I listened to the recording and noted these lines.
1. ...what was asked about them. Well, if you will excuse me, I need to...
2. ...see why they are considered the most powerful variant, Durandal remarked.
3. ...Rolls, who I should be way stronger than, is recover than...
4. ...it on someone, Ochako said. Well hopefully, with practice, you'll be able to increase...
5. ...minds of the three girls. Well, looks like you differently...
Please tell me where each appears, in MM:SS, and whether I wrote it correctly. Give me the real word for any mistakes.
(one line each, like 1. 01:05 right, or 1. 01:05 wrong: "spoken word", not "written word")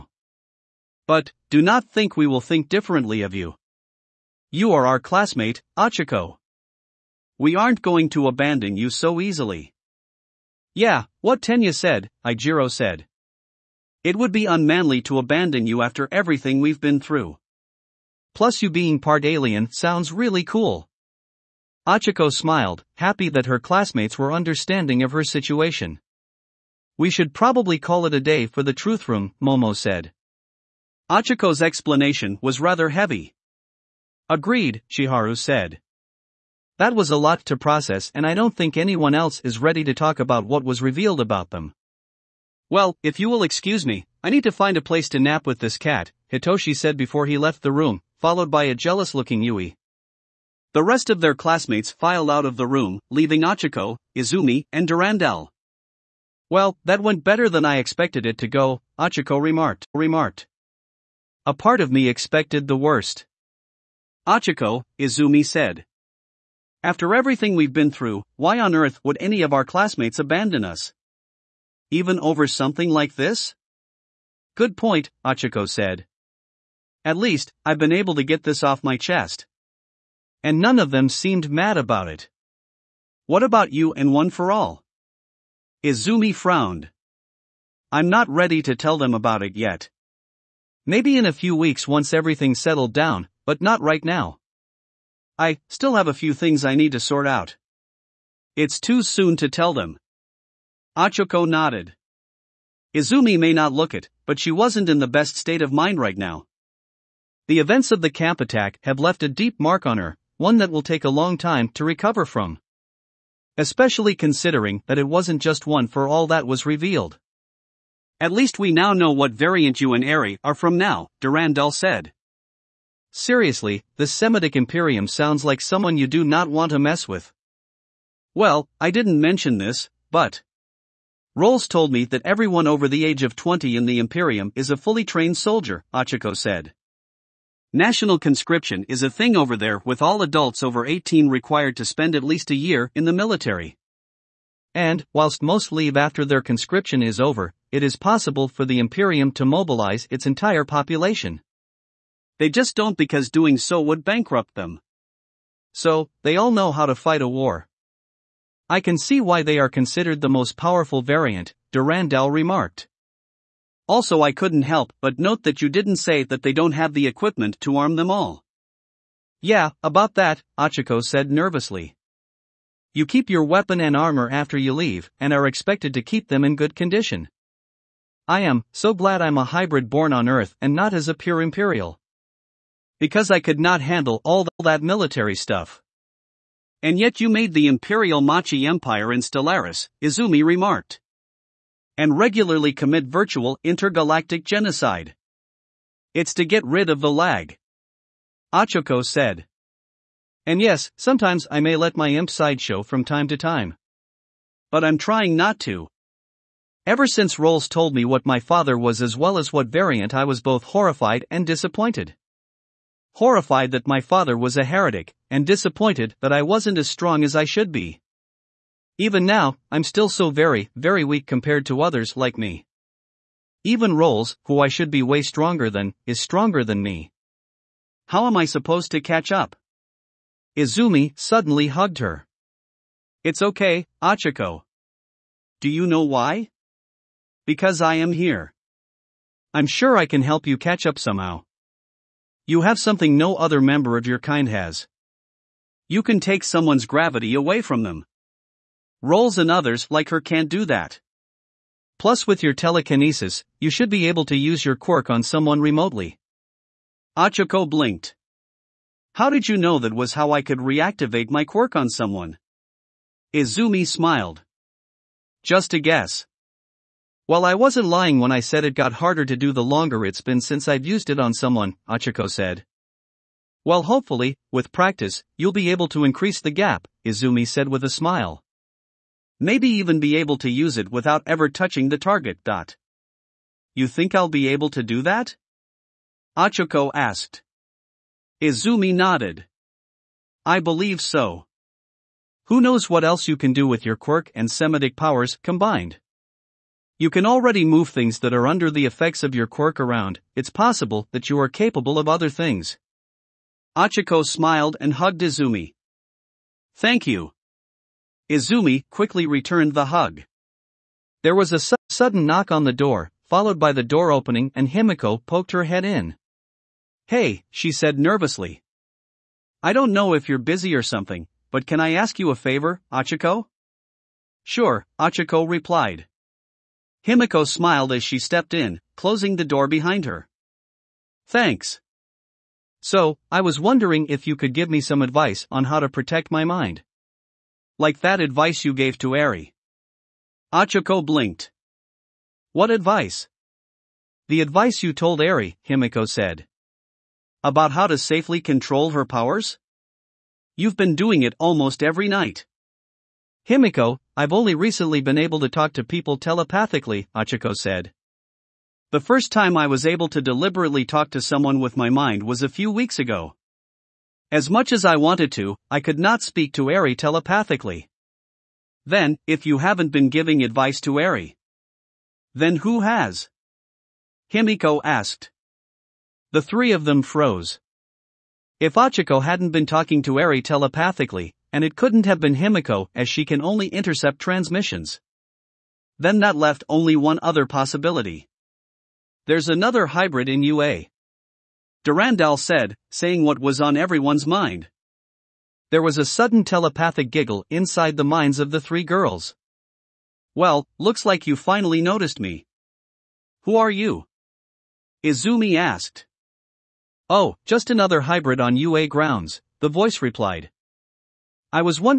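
1. 00:40 wrong: "revealed", not "asked"
2. 02:38 right
3. 03:43 wrong: "stronger", not "recover"
4. 04:31 right
5. 06:38 wrong: "finally", not "differently".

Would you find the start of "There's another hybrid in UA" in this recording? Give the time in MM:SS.
06:29.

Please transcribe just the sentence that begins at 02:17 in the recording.
National conscription is a thing over there with all adults over 18 required to spend at least a year in the military.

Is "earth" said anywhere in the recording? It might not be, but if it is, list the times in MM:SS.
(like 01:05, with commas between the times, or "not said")
01:08, 03:00.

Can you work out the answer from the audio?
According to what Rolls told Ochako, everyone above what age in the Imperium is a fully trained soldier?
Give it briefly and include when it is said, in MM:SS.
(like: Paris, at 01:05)
20, at 02:13.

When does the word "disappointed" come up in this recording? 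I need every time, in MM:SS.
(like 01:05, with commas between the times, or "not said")
03:31, 03:35.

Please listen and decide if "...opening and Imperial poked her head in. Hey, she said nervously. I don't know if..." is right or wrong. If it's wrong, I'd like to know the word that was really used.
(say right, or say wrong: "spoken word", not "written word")
wrong: "Himiko", not "Imperial".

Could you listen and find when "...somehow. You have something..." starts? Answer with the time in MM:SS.
04:00.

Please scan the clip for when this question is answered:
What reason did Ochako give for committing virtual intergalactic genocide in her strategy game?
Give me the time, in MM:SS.
03:16.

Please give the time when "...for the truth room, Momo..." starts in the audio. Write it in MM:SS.
00:28.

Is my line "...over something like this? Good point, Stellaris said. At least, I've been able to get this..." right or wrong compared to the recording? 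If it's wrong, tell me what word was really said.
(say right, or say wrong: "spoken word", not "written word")
wrong: "Ochako", not "Stellaris".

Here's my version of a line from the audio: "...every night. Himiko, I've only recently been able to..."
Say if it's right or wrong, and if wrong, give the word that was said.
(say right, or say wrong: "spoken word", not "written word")
right.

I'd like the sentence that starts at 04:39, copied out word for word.
Maybe even be able to use it without ever touching the target.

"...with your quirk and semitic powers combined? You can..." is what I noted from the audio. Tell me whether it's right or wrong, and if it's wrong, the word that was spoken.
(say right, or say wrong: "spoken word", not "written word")
right.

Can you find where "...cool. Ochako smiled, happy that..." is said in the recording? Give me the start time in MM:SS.
00:20.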